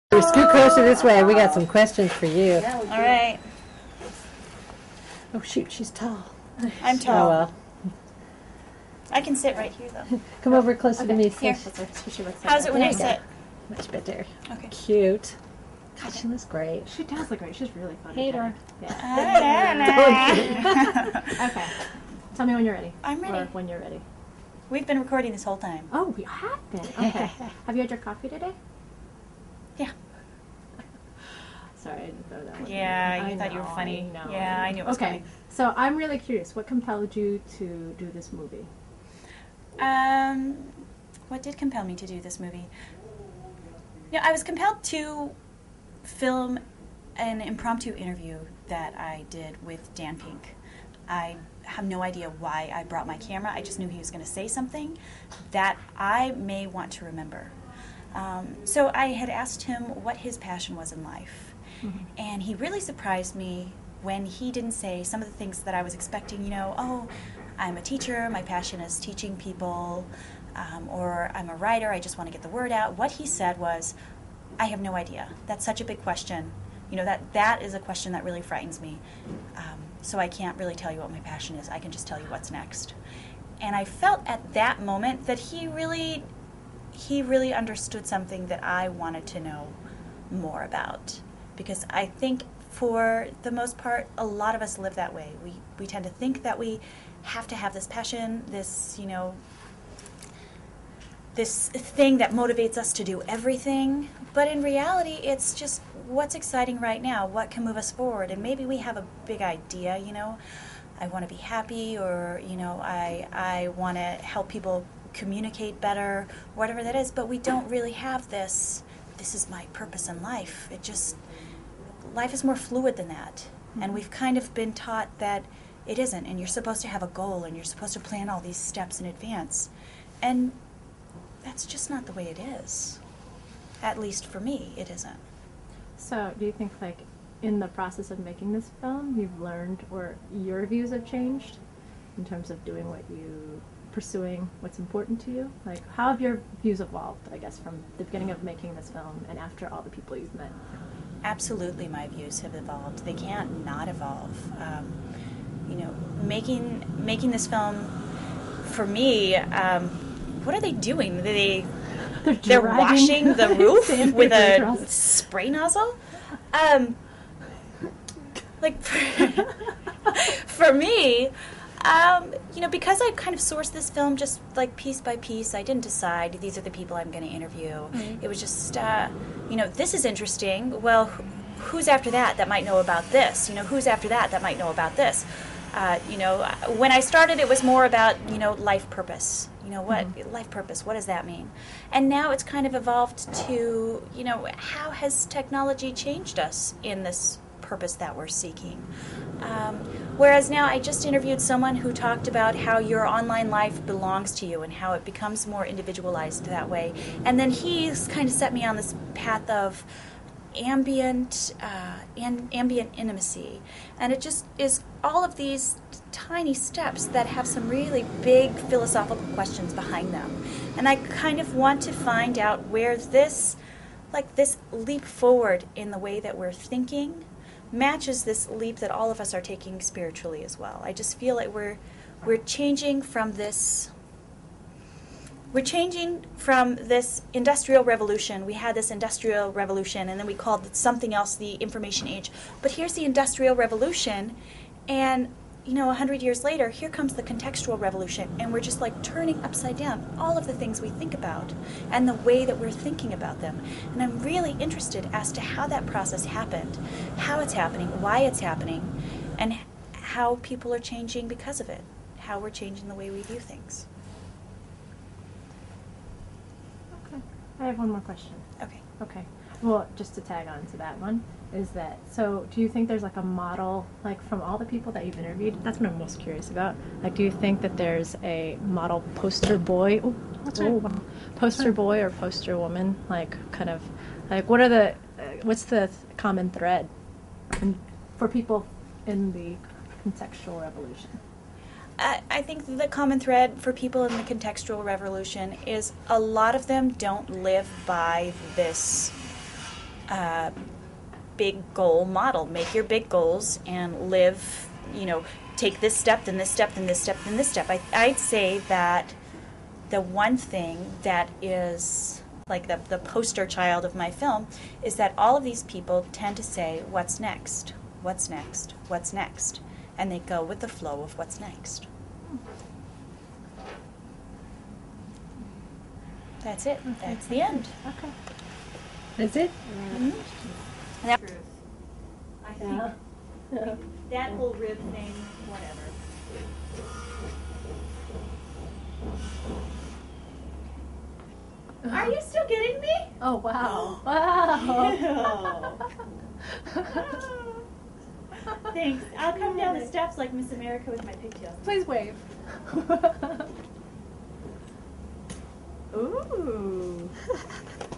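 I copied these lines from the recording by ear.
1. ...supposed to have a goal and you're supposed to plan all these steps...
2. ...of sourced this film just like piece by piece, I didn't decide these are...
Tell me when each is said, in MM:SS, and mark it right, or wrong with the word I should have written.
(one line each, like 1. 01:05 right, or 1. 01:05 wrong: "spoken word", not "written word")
1. 02:06 right
2. 02:53 right.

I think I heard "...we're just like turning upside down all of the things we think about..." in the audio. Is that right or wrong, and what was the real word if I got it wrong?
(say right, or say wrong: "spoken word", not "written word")
right.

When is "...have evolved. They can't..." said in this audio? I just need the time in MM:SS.
02:32.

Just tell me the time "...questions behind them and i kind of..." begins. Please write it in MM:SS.
03:39.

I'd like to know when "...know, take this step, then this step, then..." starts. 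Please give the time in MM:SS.
05:05.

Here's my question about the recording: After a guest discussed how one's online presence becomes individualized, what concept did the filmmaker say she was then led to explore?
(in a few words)
ambient intimacy.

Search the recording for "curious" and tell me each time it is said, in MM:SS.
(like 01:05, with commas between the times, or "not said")
00:36, 04:36.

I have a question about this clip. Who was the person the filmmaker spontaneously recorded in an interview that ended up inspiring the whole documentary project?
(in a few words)
Dan Pink.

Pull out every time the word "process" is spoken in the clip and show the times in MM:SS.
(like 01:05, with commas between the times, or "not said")
02:17, 04:15.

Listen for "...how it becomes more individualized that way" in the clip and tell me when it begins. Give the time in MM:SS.
03:24.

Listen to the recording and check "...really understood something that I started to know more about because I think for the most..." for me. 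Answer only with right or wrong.
wrong.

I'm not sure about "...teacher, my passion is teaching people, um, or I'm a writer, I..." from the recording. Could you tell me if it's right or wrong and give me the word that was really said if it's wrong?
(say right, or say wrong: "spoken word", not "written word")
right.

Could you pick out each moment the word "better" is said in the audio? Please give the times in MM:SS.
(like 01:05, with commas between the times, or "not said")
00:13, 01:55.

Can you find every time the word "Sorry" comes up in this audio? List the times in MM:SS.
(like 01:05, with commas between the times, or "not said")
00:31.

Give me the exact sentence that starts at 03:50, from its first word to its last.
I just feel like we're we're changing from this we're changing from this industrial revolution.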